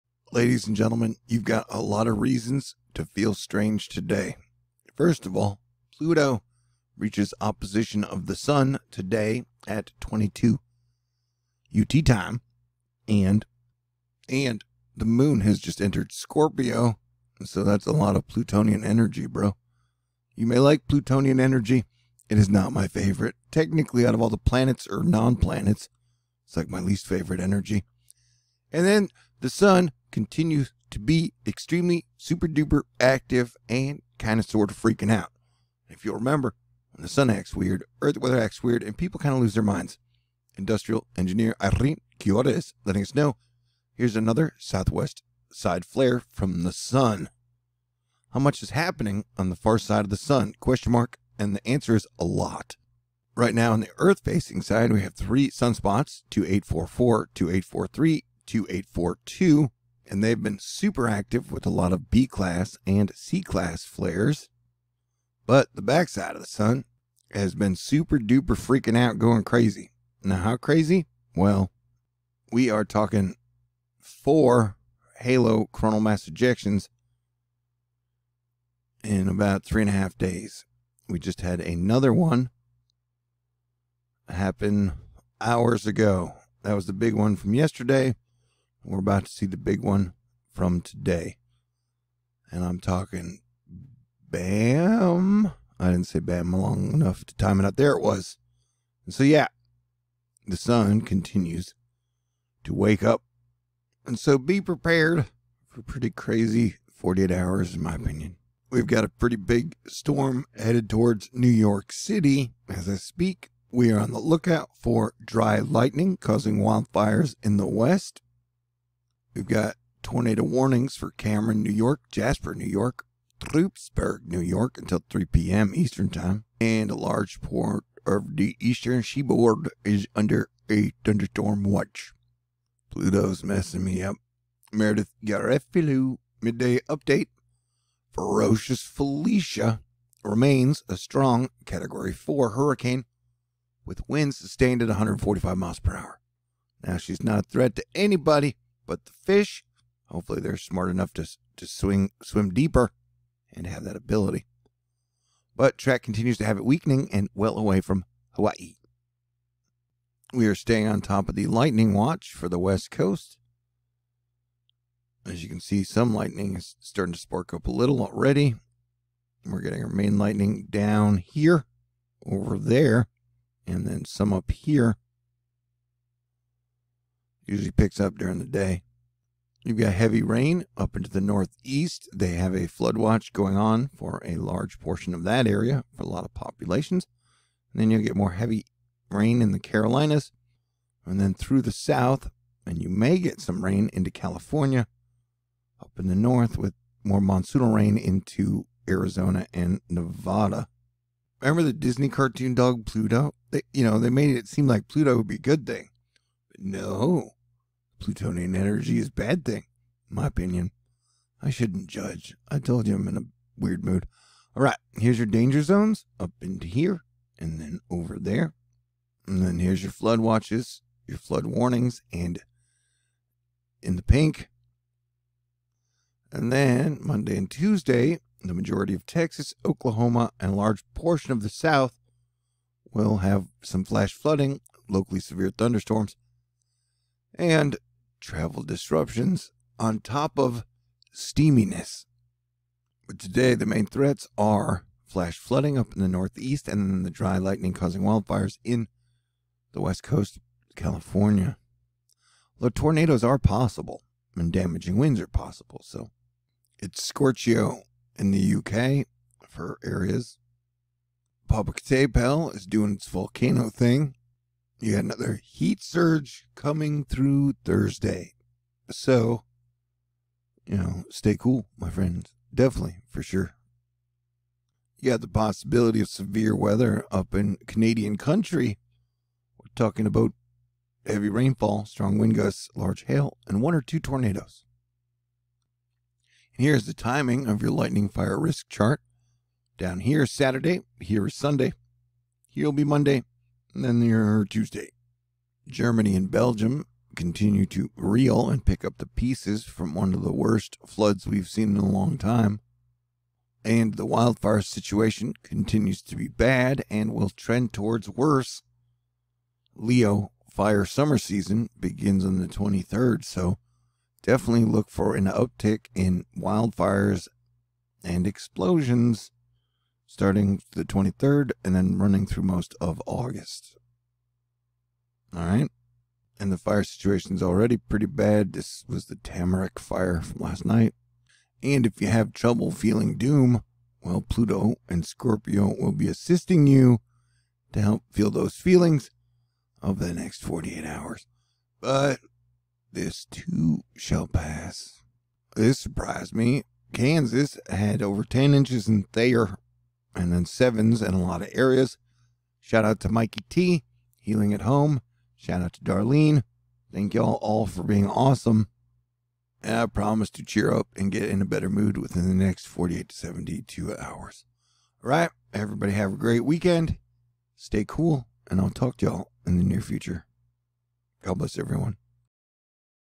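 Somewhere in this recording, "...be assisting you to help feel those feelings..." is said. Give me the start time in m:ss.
5:35.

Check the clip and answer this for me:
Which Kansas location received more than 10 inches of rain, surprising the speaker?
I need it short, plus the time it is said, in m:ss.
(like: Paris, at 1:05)
Thayer, at 5:49.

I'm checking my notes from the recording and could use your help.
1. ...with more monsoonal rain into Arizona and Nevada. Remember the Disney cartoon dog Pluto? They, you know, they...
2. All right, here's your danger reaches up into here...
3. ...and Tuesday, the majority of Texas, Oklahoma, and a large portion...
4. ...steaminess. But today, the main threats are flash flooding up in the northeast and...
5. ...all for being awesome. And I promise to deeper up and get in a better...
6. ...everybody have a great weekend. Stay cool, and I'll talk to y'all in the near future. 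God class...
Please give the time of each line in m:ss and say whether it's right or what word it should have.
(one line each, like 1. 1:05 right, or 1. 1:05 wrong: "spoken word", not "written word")
1. 3:16 right
2. 3:34 wrong: "zones", not "reaches"
3. 3:47 right
4. 4:01 right
5. 5:57 wrong: "cheer", not "deeper"
6. 6:05 wrong: "bless", not "class".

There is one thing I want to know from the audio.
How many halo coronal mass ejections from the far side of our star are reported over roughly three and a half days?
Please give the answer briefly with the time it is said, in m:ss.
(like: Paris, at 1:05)
4, at 1:14.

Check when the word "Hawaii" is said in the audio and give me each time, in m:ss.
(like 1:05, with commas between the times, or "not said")
2:38.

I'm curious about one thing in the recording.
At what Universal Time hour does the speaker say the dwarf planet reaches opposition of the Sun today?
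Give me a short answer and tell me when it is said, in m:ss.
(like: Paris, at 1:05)
22 UT, at 0:09.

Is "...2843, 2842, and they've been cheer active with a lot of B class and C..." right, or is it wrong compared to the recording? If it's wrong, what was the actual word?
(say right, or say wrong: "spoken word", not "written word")
wrong: "super", not "cheer".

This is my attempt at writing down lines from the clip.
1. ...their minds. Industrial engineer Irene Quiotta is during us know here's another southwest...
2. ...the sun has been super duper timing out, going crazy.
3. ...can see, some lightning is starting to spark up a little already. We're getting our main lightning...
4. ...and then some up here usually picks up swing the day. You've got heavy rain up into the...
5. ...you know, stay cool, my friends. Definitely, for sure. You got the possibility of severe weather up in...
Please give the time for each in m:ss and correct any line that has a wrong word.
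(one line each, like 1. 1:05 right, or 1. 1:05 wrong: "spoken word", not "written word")
1. 0:39 wrong: "letting", not "during"
2. 1:06 wrong: "freaking", not "timing"
3. 2:45 right
4. 2:53 wrong: "during", not "swing"
5. 4:30 right.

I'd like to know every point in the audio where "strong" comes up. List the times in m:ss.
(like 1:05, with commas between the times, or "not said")
2:20, 4:41.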